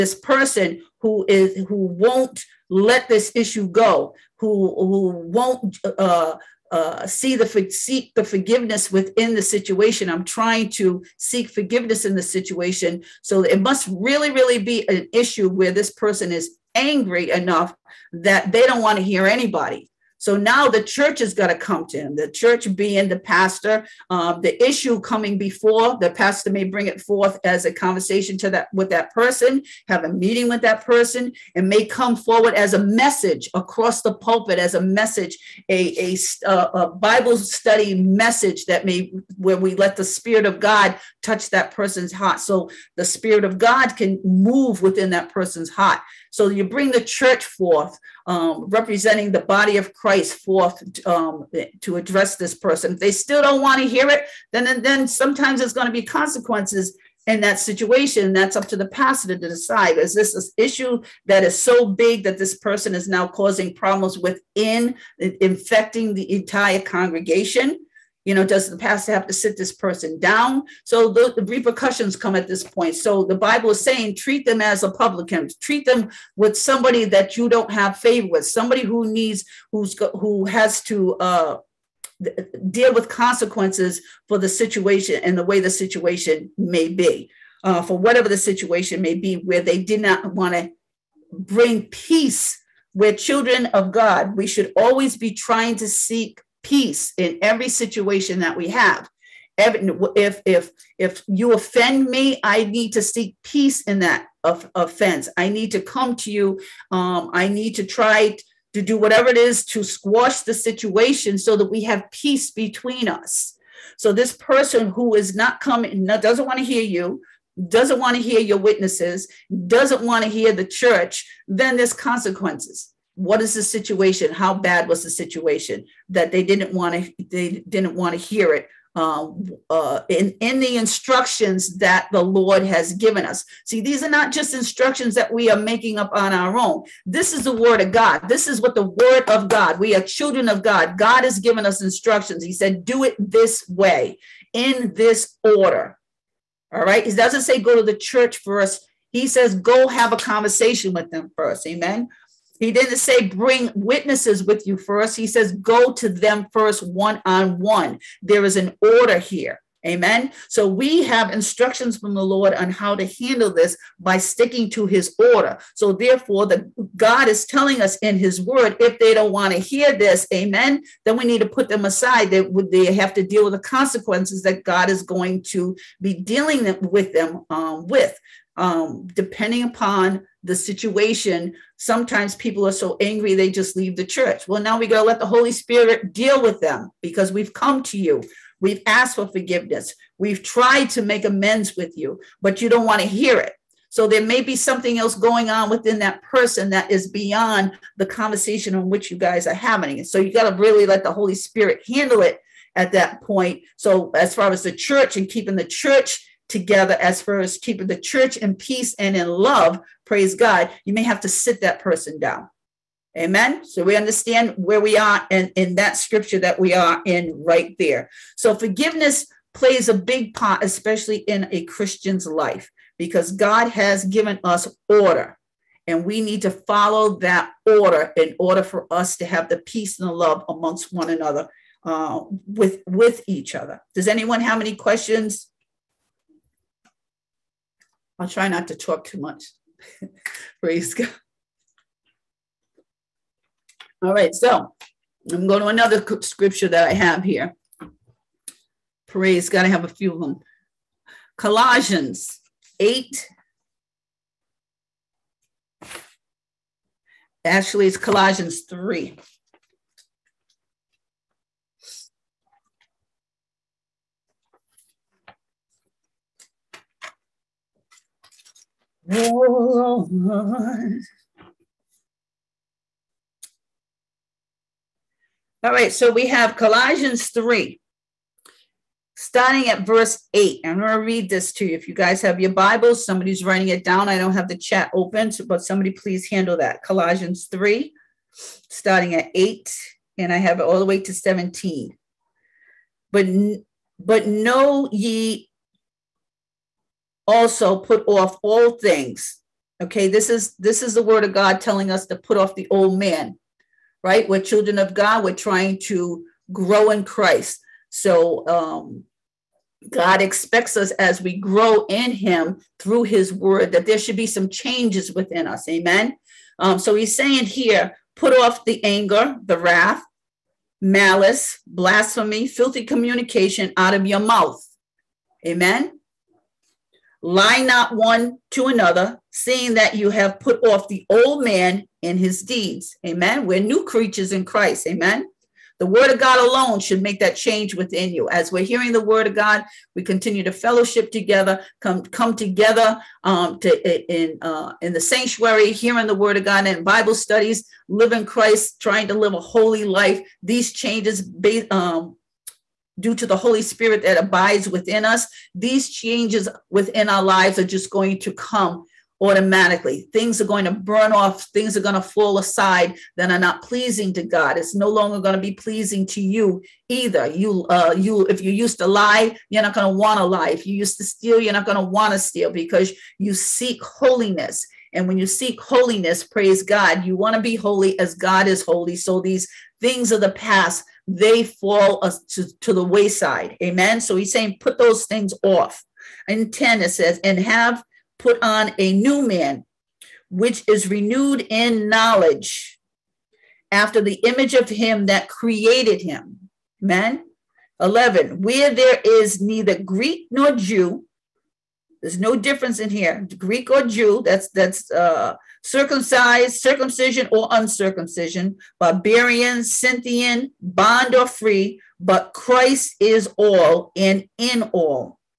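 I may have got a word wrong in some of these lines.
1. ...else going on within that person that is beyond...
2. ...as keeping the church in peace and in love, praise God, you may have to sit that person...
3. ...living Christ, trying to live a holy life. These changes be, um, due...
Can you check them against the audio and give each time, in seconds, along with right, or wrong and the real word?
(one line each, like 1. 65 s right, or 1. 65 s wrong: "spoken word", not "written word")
1. 194 s right
2. 207 s right
3. 347 s right.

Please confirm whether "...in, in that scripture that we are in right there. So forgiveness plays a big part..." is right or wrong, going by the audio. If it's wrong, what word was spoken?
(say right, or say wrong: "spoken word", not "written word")
right.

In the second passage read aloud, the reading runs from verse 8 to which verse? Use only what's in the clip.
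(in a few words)
17.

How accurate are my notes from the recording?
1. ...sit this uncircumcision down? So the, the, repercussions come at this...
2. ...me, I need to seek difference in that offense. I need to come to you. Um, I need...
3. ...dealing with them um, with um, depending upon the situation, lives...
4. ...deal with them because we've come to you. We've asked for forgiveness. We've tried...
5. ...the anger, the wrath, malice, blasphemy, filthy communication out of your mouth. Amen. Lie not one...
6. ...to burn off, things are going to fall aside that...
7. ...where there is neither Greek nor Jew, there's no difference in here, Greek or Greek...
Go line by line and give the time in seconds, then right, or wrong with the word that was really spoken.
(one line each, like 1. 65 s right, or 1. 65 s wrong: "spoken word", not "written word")
1. 69 s wrong: "person", not "uncircumcision"
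2. 102 s wrong: "peace", not "difference"
3. 176 s wrong: "sometimes", not "lives"
4. 186 s right
5. 318 s right
6. 360 s right
7. 398 s wrong: "Jew", not "Greek".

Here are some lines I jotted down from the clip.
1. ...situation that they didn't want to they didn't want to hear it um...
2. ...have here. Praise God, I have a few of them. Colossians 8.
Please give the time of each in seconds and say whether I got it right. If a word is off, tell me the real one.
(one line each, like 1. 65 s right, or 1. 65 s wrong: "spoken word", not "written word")
1. 125 s right
2. 246 s right.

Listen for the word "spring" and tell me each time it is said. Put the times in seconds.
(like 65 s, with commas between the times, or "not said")
not said.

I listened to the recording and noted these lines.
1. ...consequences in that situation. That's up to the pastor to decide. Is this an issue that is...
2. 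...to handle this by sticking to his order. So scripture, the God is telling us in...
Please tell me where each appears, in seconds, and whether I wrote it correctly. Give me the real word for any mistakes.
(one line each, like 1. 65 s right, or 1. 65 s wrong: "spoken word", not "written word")
1. 56 s right
2. 162 s wrong: "therefore", not "scripture".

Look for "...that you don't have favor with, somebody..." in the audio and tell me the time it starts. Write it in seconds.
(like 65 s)
77 s.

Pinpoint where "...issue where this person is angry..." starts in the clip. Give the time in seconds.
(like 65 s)
15 s.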